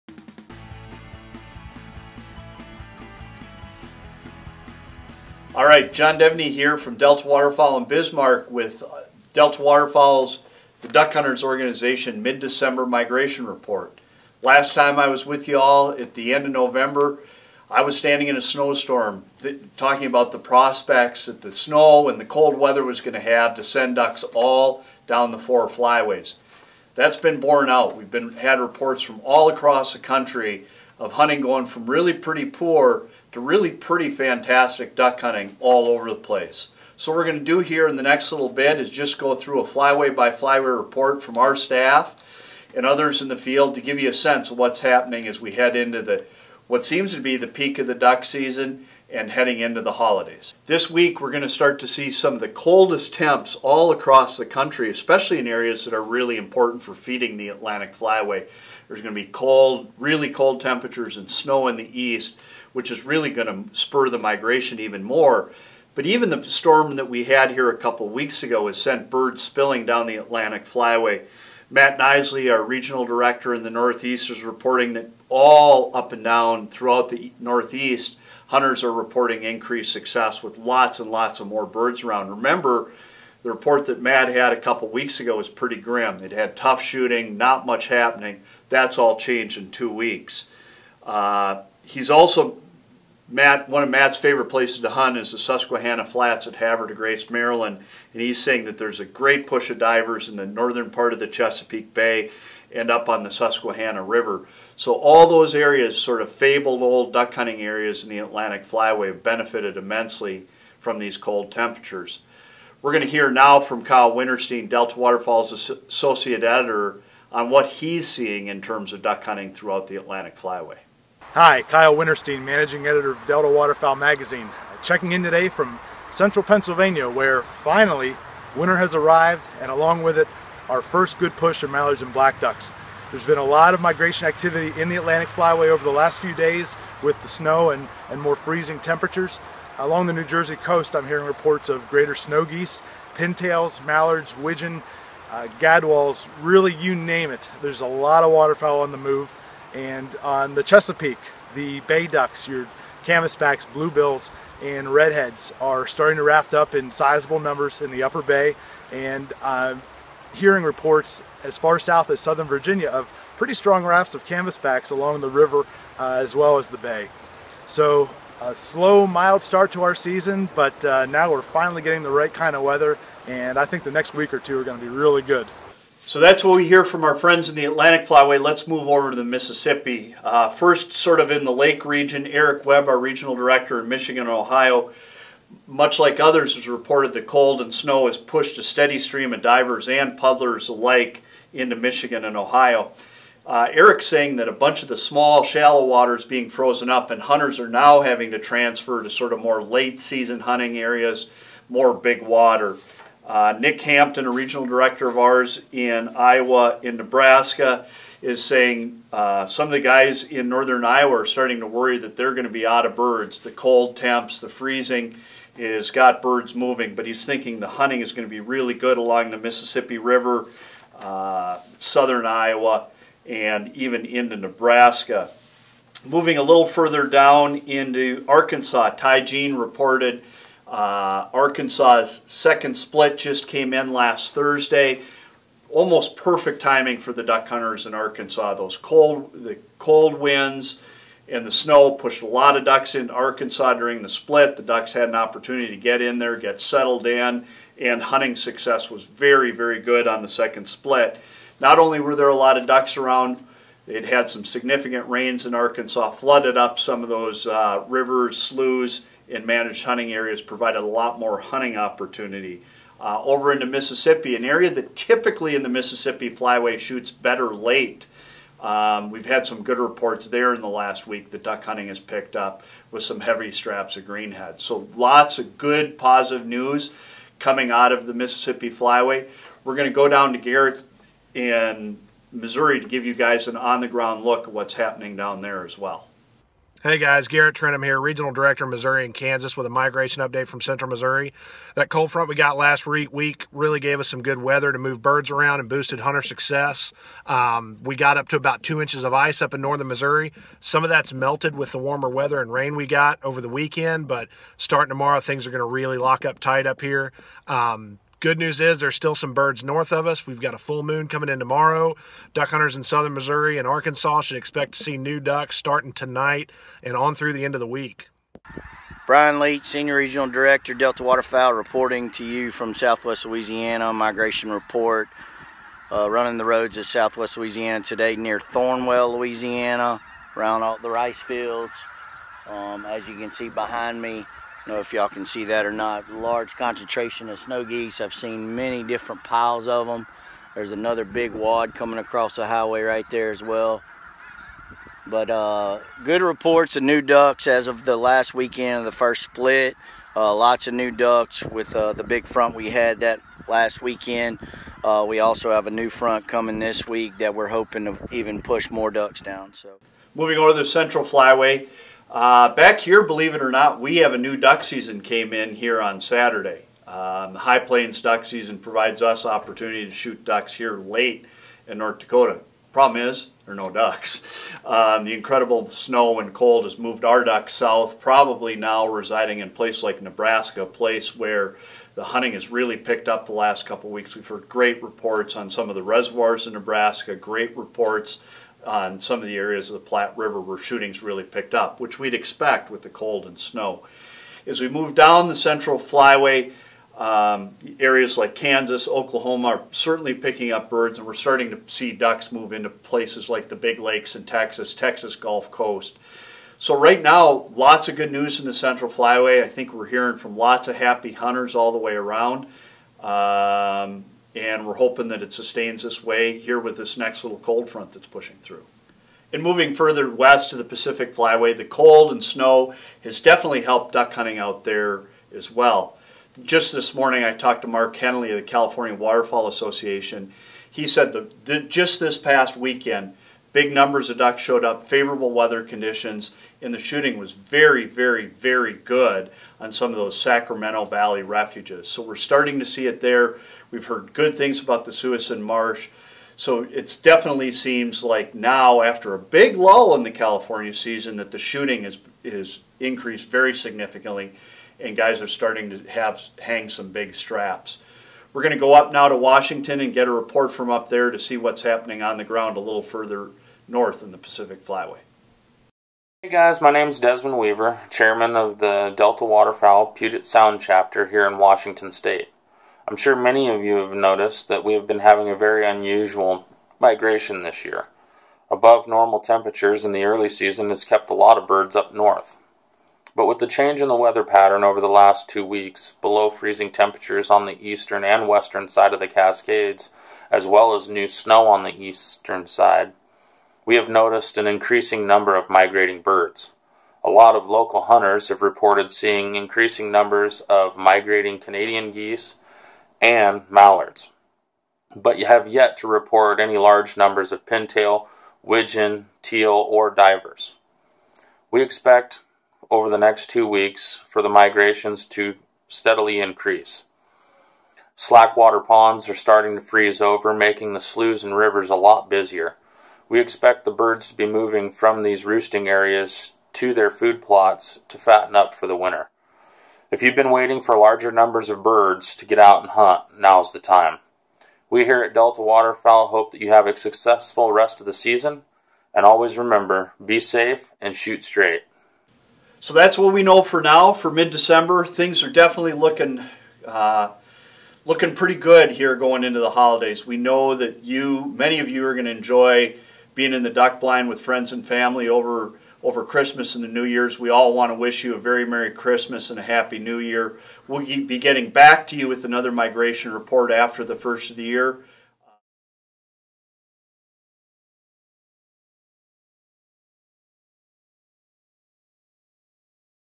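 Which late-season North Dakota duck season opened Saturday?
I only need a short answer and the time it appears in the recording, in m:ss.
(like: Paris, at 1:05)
High Plains, at 6:07.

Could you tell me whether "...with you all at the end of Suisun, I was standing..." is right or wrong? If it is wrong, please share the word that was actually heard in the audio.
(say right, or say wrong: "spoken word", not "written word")
wrong: "November", not "Suisun".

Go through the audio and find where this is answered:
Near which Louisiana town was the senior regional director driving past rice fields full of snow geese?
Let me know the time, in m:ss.
5:28.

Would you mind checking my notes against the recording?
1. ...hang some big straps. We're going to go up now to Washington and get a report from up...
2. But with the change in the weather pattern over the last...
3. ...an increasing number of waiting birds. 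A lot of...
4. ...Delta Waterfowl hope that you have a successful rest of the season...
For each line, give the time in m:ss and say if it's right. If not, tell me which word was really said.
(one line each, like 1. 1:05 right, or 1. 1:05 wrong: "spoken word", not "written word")
1. 7:36 right
2. 8:03 right
3. 8:14 wrong: "migrating", not "waiting"
4. 8:55 right.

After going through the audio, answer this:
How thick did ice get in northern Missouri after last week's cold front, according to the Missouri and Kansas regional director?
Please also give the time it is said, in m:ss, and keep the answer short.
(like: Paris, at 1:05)
2 inches, at 4:58.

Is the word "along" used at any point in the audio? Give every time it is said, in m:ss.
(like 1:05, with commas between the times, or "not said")
2:09, 2:19, 2:44, 3:38.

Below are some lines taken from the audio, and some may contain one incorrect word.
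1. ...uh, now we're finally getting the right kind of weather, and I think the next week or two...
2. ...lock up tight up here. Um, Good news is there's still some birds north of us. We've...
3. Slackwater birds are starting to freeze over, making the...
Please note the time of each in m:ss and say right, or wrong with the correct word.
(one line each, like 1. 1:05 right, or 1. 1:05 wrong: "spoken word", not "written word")
1. 2:50 right
2. 5:05 right
3. 8:37 wrong: "ponds", not "birds".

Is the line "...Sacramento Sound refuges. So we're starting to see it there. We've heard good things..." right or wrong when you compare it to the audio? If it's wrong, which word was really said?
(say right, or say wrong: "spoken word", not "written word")
wrong: "Valley", not "Sound".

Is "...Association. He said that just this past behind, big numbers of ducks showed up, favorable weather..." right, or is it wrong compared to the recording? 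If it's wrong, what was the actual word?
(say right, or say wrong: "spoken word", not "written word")
wrong: "weekend", not "behind".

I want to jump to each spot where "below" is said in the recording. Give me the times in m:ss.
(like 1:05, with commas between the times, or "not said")
8:06.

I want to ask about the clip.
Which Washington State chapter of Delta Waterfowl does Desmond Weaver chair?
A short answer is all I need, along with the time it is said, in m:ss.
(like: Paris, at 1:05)
Puget Sound, at 7:49.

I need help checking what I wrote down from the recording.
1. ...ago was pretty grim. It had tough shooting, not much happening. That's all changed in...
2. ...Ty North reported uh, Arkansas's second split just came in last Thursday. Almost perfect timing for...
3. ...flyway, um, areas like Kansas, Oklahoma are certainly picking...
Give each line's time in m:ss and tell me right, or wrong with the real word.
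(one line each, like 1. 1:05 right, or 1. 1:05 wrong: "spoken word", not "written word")
1. 1:25 right
2. 3:48 wrong: "Jean", not "North"
3. 6:35 right.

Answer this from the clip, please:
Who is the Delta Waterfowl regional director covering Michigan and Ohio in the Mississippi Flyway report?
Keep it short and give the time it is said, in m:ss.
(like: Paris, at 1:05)
Eric Webb, at 3:02.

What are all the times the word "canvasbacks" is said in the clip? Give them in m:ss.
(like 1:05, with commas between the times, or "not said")
2:33, 2:44.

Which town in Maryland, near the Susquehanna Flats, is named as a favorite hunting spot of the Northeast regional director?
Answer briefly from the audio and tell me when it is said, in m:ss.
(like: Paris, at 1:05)
Havre Grace, at 1:36.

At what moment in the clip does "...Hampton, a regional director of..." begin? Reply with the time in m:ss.
3:23.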